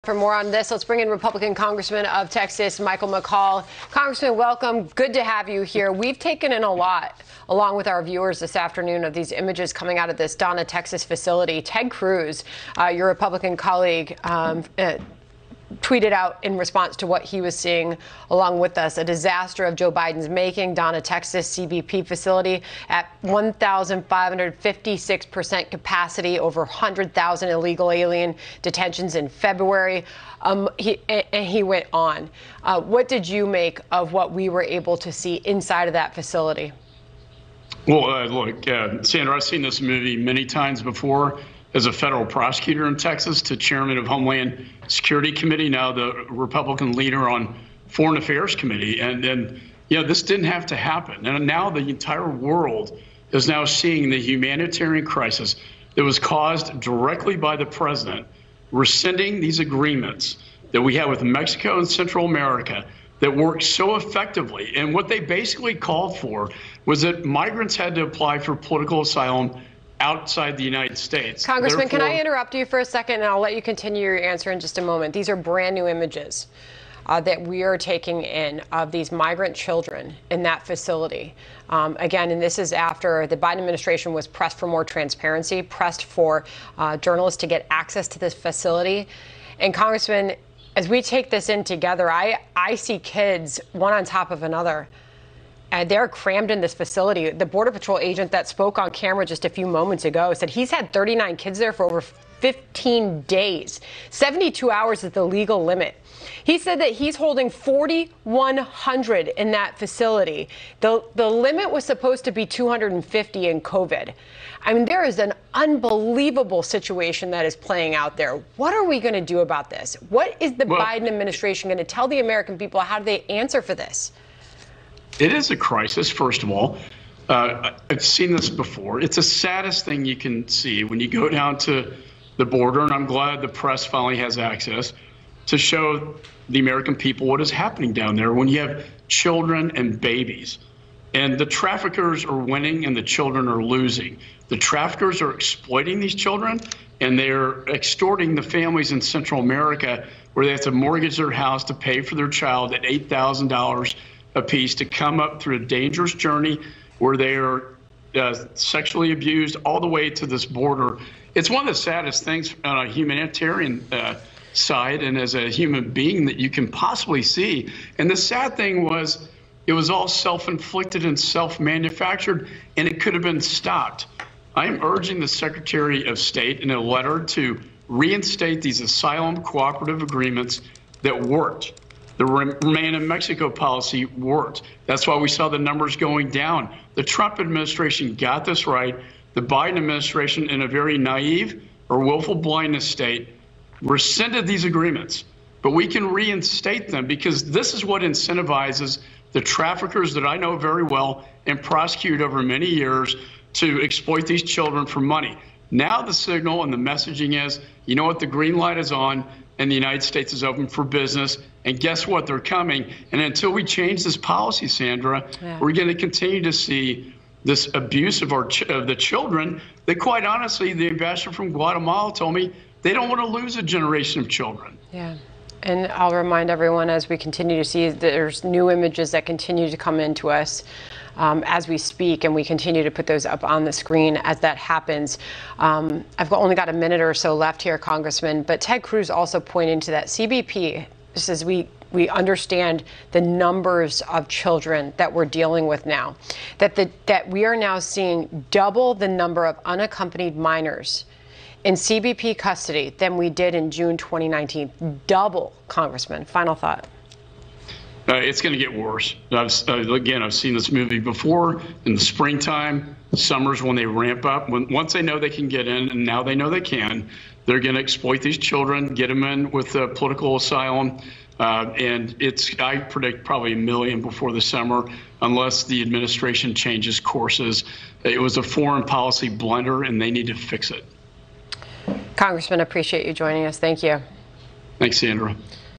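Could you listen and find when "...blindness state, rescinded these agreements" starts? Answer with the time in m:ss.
3:12.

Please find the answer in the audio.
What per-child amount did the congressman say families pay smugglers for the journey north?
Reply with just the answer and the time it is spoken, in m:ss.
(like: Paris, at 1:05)
$8,000, at 2:32.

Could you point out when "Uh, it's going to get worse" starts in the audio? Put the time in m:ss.
4:18.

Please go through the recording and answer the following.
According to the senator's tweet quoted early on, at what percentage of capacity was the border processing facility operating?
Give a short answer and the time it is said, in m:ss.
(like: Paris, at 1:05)
1,556%, at 0:23.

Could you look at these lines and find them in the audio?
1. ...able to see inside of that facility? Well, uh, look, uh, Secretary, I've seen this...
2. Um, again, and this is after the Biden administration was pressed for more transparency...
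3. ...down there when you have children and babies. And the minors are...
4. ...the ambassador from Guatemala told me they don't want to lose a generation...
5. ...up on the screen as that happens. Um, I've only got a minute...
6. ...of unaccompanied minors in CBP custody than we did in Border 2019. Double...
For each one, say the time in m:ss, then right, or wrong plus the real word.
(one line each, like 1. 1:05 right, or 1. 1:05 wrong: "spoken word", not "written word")
1. 0:34 wrong: "Sandra", not "Secretary"
2. 1:21 right
3. 2:17 wrong: "traffickers", not "minors"
4. 3:40 right
5. 3:53 right
6. 4:09 wrong: "June", not "Border".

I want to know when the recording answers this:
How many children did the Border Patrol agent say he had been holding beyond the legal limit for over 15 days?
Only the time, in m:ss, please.
1:40.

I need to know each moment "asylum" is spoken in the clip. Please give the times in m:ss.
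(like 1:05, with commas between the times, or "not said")
1:09, 2:58, 4:30.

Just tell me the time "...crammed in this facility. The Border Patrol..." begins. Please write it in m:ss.
1:36.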